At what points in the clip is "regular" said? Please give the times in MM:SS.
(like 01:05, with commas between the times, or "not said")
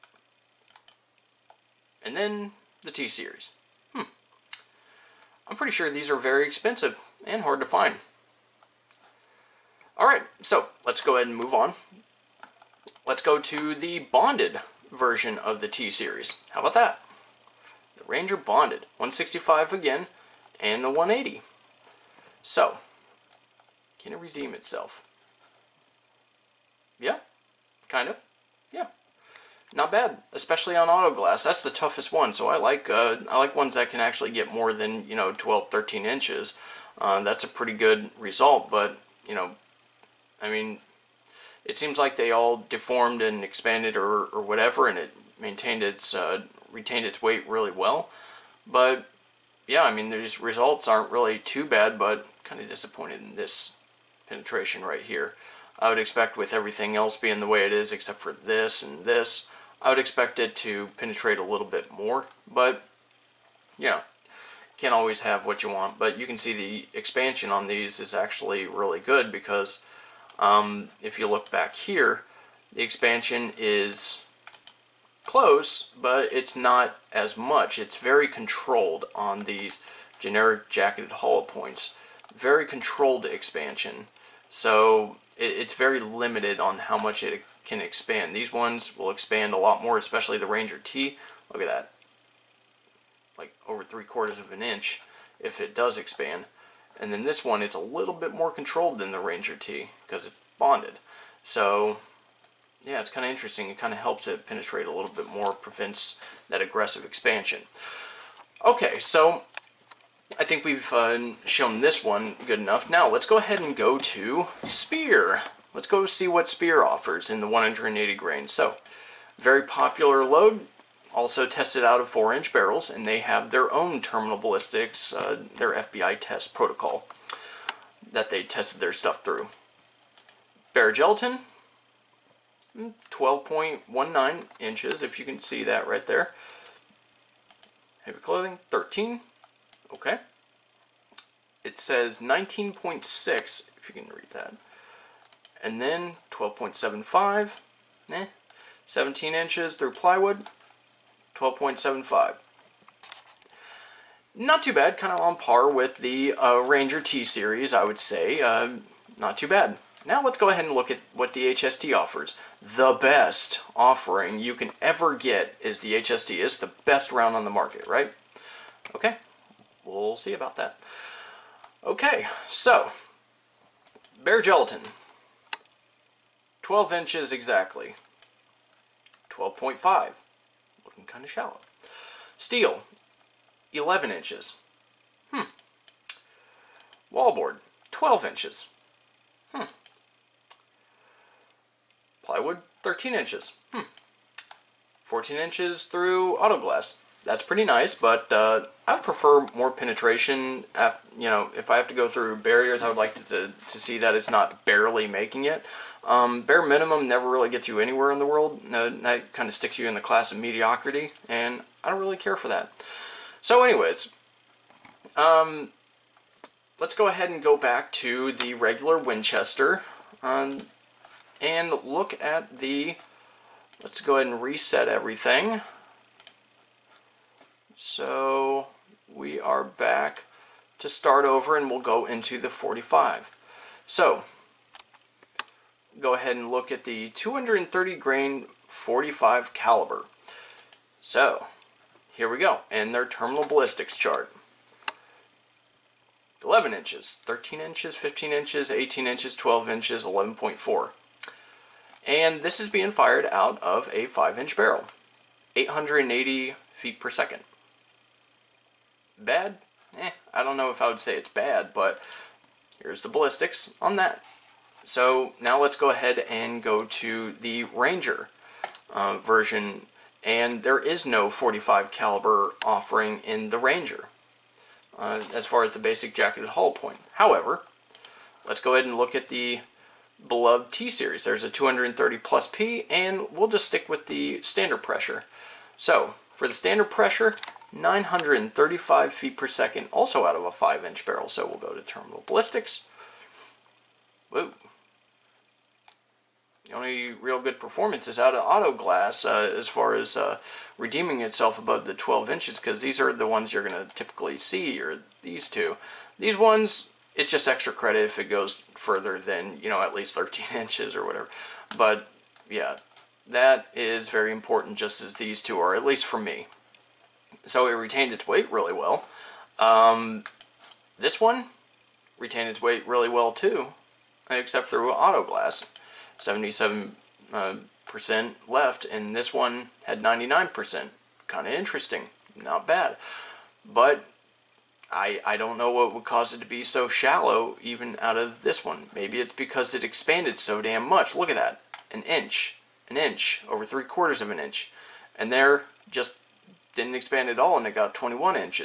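03:38.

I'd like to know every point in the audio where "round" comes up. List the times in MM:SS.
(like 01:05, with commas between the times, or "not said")
02:47.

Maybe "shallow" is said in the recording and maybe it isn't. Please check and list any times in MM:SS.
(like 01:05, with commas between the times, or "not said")
03:01, 05:36.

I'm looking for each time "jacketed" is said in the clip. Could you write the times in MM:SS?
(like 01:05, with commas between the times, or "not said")
01:20, 04:36.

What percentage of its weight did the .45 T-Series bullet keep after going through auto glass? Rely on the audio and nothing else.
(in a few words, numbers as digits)
77%.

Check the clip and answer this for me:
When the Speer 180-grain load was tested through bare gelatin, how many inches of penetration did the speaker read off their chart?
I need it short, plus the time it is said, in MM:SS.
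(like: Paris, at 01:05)
12.19 inches, at 02:13.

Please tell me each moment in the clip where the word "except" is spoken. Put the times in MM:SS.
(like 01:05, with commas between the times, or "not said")
00:57, 05:24.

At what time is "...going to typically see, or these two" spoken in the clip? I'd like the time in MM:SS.
05:03.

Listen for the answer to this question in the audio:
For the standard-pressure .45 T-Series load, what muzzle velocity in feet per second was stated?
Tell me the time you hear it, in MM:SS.
04:47.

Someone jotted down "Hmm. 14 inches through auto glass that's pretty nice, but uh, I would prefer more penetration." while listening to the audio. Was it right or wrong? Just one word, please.
right.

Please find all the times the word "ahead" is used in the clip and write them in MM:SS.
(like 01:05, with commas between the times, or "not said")
00:11, 01:53, 02:40, 03:37, 03:44, 03:56, 04:25, 04:38.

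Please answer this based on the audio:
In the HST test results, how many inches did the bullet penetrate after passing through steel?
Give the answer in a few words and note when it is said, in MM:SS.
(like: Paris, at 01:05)
11 inches, at 03:02.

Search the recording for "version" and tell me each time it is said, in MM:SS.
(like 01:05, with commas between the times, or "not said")
00:14, 04:29.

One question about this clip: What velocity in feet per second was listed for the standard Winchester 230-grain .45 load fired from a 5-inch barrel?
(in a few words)
880.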